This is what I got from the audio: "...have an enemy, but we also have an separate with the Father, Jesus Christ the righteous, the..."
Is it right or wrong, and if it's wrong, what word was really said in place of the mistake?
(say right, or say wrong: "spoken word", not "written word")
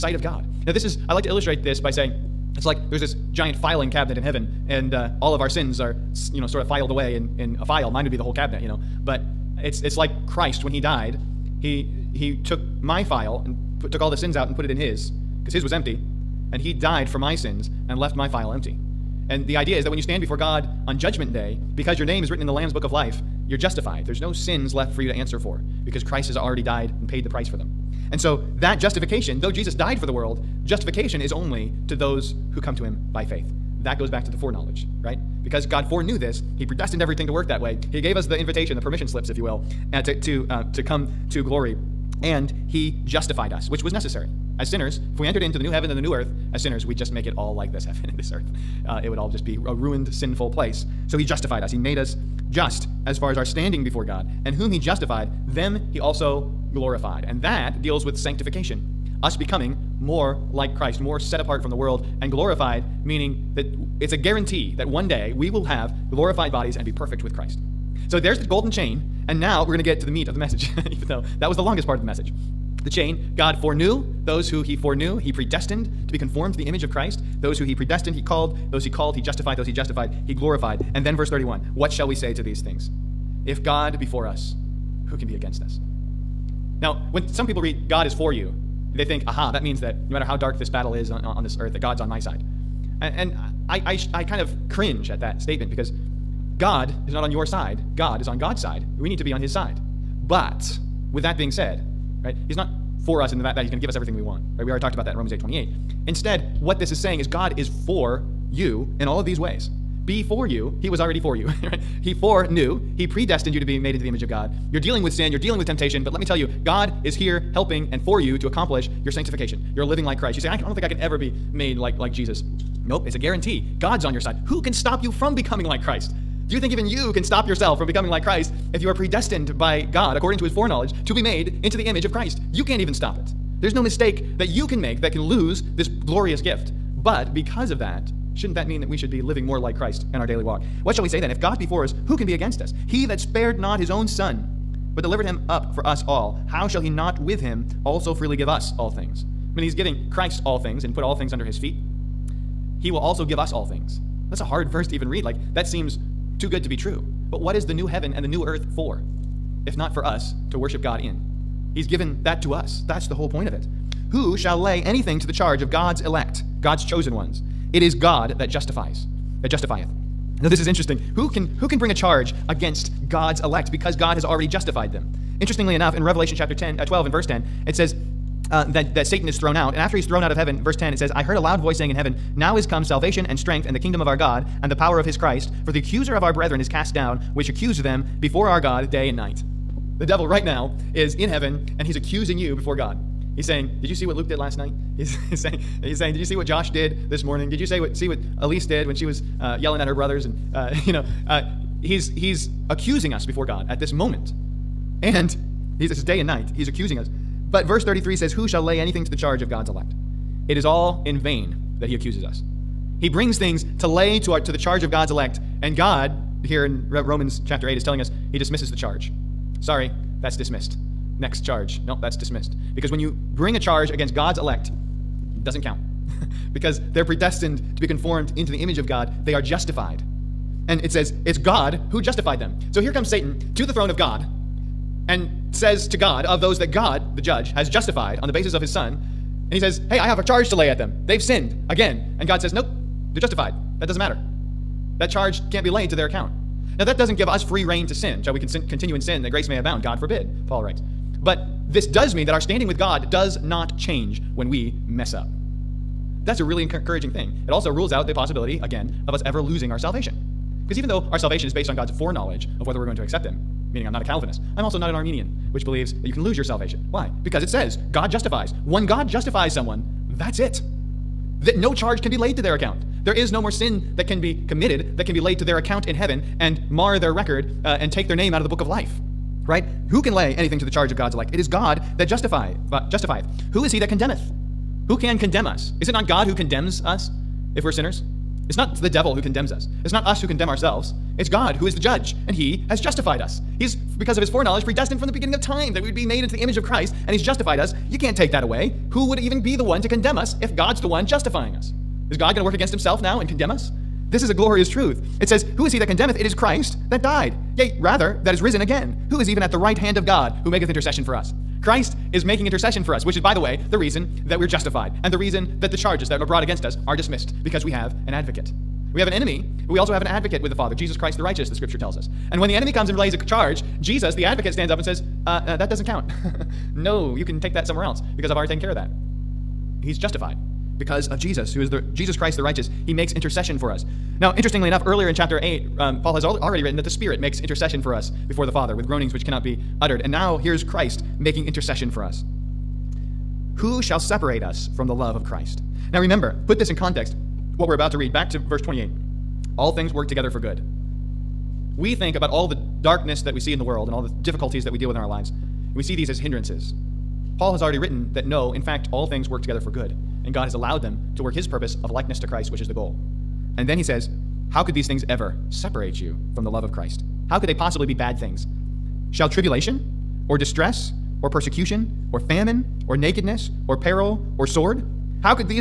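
wrong: "advocate", not "separate".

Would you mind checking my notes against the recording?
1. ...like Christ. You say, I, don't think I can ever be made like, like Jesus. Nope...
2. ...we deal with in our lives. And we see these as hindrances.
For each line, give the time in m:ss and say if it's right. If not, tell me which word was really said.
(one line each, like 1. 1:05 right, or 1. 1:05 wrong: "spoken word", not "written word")
1. 2:00 right
2. 5:54 right.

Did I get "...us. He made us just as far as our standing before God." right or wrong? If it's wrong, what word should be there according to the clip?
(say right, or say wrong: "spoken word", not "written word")
right.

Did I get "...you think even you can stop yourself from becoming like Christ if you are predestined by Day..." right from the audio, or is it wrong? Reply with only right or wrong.
wrong.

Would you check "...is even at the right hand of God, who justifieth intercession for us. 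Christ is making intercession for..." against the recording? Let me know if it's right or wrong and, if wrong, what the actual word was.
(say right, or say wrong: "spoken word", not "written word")
wrong: "maketh", not "justifieth".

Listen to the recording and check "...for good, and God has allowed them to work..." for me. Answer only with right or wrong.
right.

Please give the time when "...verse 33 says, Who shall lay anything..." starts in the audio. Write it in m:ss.
3:27.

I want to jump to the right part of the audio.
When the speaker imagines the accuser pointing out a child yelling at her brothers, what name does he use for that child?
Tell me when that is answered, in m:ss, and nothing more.
3:18.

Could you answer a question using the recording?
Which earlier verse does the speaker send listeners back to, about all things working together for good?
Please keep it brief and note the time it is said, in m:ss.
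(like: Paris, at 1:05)
verse 28, at 5:48.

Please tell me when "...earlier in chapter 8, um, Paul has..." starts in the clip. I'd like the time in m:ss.
5:34.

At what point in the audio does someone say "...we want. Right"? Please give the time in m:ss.
1:44.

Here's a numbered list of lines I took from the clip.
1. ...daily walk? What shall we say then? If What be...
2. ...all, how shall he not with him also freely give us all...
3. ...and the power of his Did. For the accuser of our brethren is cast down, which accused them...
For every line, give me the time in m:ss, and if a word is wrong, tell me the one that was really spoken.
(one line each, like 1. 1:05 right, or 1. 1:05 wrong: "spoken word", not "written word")
1. 2:20 wrong: "God", not "What"
2. 2:26 right
3. 3:04 wrong: "Christ", not "Did".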